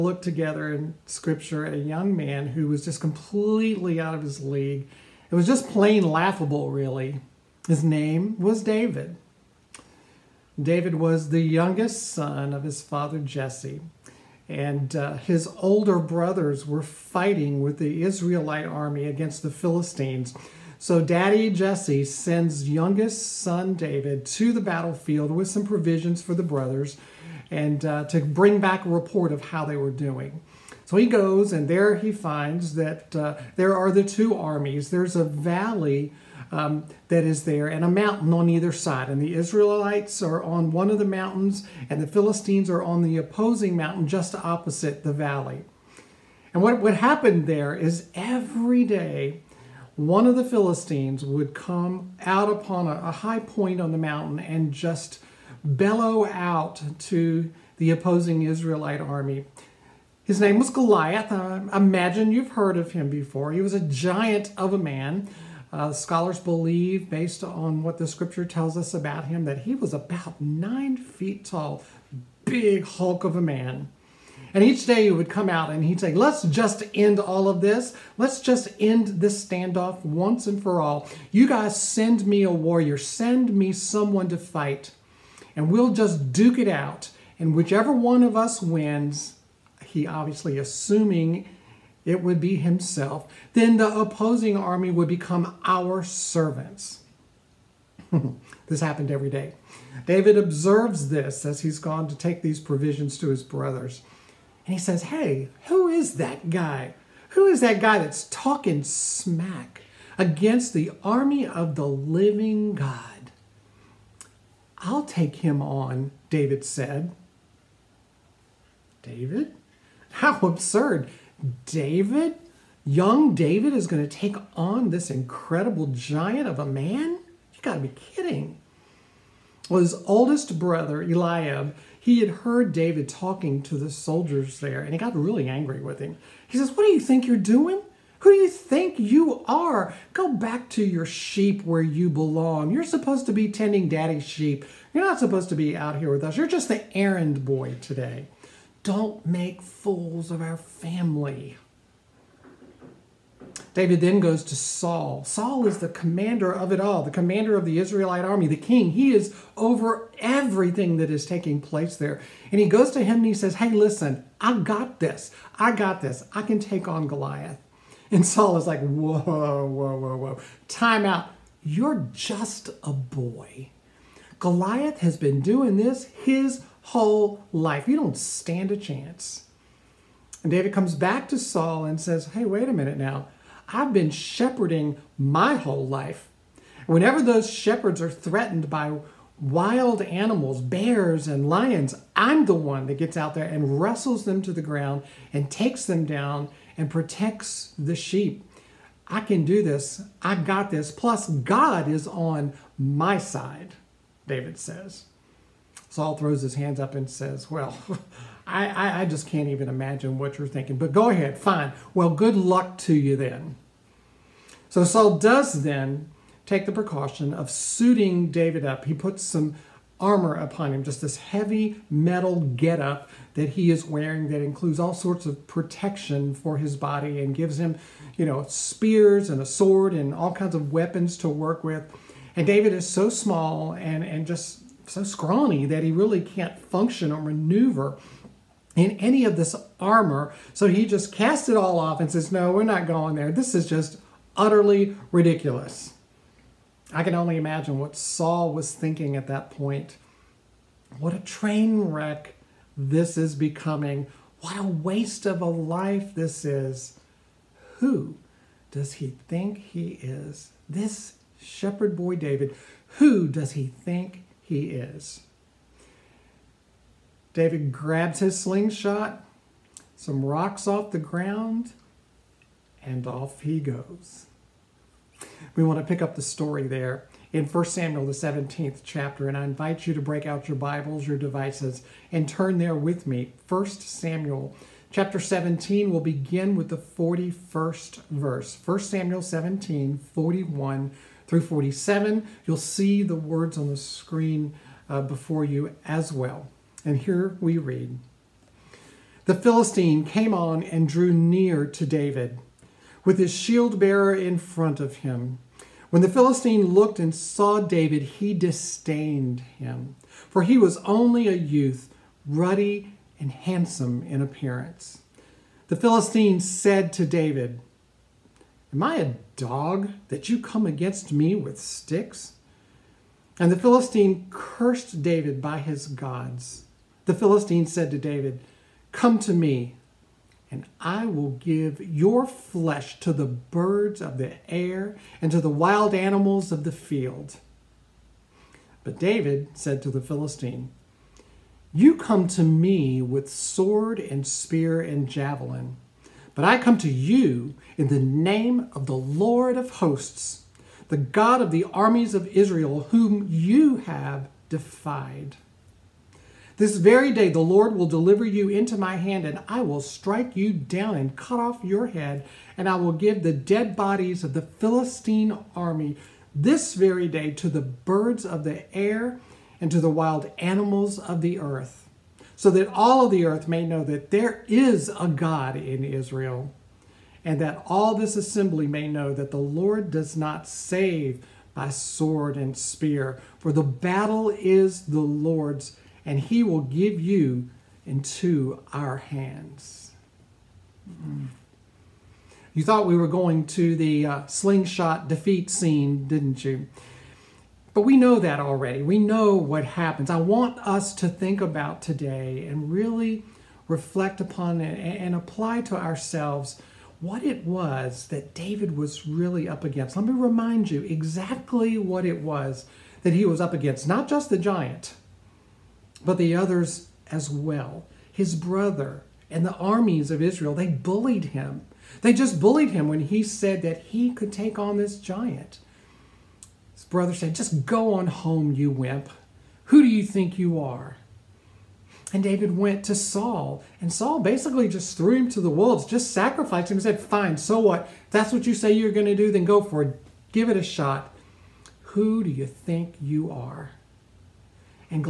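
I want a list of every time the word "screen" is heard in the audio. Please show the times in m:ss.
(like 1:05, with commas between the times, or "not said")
4:53.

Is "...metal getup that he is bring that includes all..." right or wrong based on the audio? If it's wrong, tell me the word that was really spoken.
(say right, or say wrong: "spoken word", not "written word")
wrong: "wearing", not "bring".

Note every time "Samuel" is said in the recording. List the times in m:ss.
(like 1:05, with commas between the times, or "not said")
4:37, 4:43, 4:48.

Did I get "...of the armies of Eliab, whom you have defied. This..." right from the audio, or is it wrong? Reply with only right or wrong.
wrong.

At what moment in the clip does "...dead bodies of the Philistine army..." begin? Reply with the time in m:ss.
6:03.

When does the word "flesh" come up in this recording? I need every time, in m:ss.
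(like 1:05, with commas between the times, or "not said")
5:32.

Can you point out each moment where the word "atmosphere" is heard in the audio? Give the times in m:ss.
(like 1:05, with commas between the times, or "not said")
not said.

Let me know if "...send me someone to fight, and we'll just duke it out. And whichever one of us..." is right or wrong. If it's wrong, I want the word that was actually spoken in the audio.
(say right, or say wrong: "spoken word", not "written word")
right.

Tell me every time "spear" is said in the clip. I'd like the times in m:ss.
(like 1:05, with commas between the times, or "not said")
3:48, 5:44, 6:22.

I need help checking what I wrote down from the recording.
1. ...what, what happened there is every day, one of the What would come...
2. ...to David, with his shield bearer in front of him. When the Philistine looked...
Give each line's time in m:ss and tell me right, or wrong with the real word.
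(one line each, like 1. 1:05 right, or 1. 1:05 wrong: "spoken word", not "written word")
1. 0:46 wrong: "Philistines", not "What"
2. 5:01 right.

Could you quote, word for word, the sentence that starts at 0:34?
There's a valley um, that is there, and a mountain on either side.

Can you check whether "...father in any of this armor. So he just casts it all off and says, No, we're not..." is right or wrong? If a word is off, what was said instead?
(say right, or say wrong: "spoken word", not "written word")
wrong: "maneuver", not "father".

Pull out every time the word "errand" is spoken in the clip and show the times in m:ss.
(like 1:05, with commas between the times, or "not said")
2:26.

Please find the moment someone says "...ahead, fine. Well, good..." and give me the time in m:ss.
3:31.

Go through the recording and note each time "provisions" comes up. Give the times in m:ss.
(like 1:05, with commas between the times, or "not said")
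0:25, 1:42.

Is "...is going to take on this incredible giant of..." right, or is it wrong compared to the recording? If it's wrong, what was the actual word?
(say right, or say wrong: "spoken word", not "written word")
right.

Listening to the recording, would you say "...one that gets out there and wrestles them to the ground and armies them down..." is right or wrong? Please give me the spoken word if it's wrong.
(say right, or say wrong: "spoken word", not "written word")
wrong: "takes", not "armies".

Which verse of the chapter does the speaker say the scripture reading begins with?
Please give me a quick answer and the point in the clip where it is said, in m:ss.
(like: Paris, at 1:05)
41, at 4:46.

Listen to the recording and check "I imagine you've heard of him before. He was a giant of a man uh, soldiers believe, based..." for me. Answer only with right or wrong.
wrong.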